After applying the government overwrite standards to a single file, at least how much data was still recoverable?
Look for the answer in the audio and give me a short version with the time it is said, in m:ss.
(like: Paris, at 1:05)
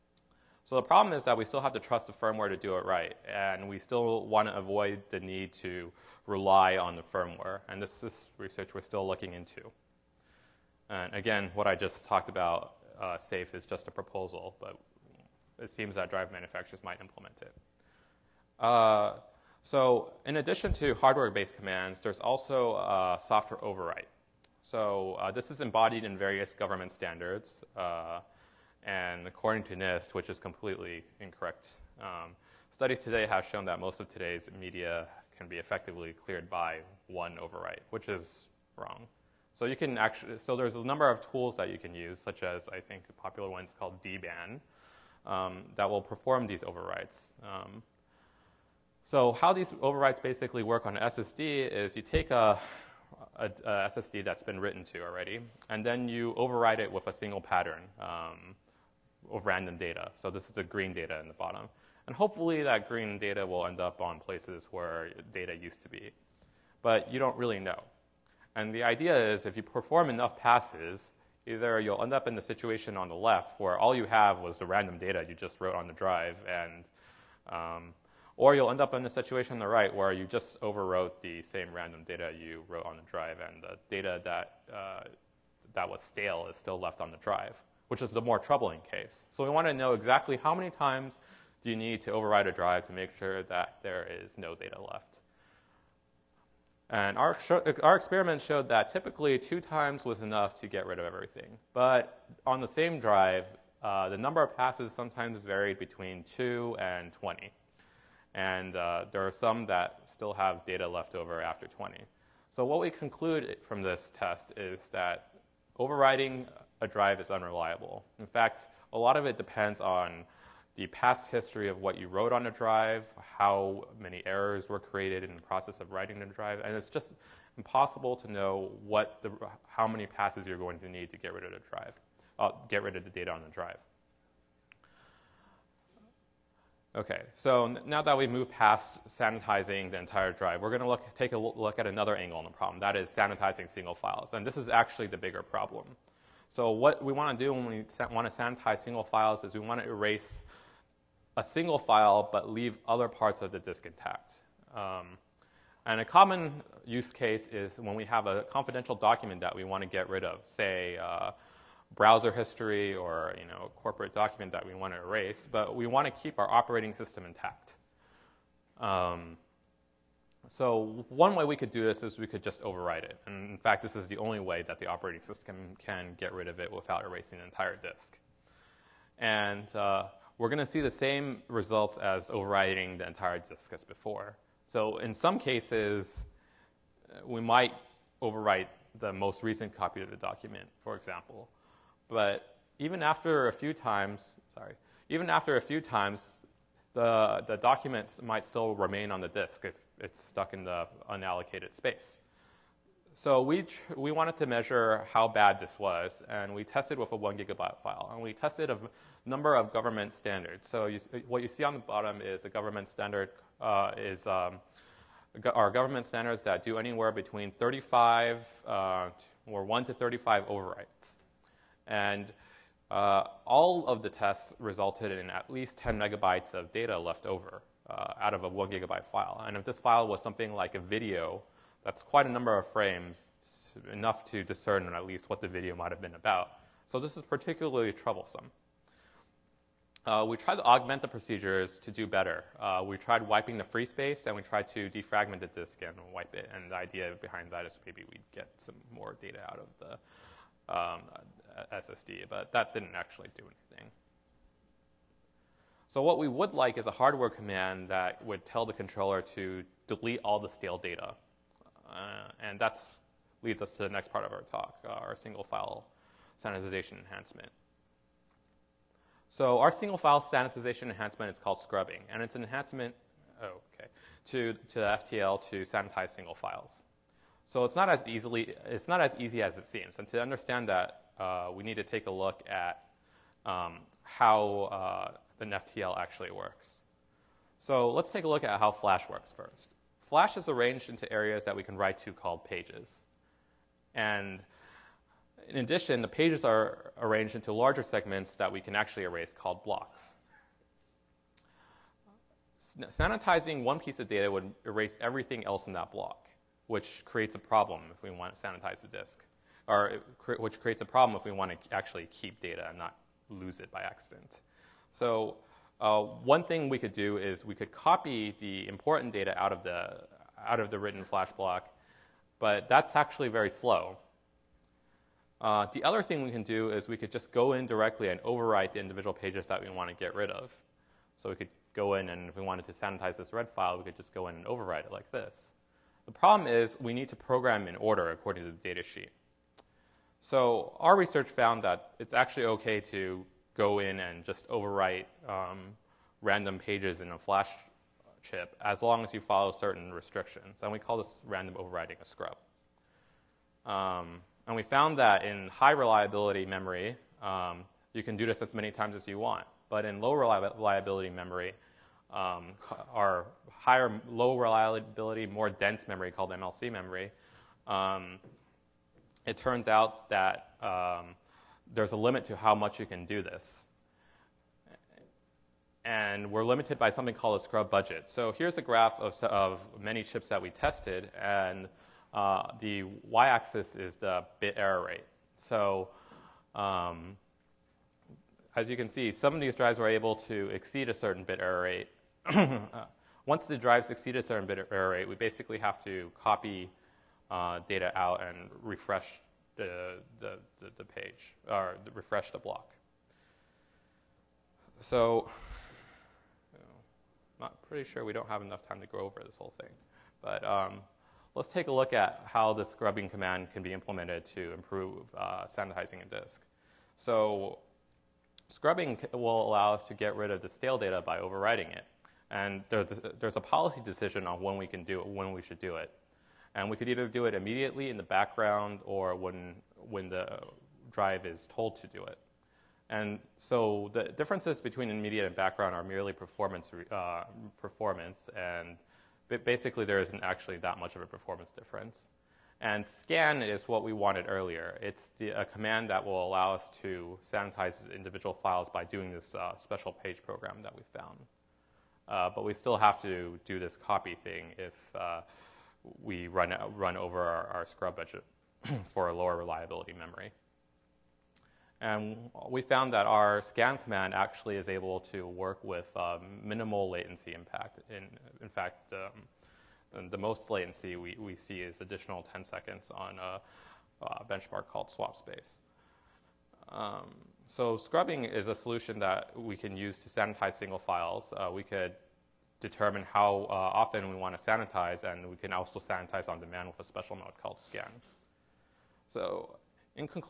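10 megabytes, at 3:45.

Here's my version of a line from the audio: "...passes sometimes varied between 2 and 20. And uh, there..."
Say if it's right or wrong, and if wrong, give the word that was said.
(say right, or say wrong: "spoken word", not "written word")
right.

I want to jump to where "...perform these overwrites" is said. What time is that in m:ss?
0:46.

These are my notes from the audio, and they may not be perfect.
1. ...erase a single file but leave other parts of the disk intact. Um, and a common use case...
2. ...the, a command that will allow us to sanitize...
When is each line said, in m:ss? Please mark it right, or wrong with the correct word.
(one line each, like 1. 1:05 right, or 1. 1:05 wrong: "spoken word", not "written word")
1. 2:29 right
2. 7:25 right.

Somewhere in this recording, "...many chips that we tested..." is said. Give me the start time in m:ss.
6:19.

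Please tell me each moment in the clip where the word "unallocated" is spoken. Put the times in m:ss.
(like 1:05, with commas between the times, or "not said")
3:21.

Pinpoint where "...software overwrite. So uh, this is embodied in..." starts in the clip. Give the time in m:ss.
0:23.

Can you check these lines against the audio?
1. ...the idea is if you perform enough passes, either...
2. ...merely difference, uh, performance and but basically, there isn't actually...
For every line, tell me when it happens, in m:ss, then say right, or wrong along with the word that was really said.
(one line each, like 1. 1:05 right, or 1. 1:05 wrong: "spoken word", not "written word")
1. 1:08 right
2. 7:15 wrong: "performance", not "difference".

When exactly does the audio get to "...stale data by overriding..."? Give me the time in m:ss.
7:00.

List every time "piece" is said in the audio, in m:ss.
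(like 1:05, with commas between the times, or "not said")
5:03.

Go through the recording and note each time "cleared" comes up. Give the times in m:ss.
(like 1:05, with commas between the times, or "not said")
0:36.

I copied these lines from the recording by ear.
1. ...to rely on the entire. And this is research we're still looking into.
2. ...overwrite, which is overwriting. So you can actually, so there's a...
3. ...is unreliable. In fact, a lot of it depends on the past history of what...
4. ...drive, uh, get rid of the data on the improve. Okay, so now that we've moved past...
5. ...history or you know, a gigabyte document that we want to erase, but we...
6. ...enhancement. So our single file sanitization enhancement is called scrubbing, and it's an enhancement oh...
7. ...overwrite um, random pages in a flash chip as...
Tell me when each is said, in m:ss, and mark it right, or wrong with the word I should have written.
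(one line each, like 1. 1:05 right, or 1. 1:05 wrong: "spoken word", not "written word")
1. 0:05 wrong: "firmware", not "entire"
2. 0:37 wrong: "wrong", not "overwriting"
3. 1:57 right
4. 2:11 wrong: "drive", not "improve"
5. 2:42 wrong: "corporate", not "gigabyte"
6. 4:26 right
7. 5:44 right.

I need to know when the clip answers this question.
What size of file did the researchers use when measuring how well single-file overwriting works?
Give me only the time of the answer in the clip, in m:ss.
3:27.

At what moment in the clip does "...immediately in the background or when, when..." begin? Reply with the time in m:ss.
7:07.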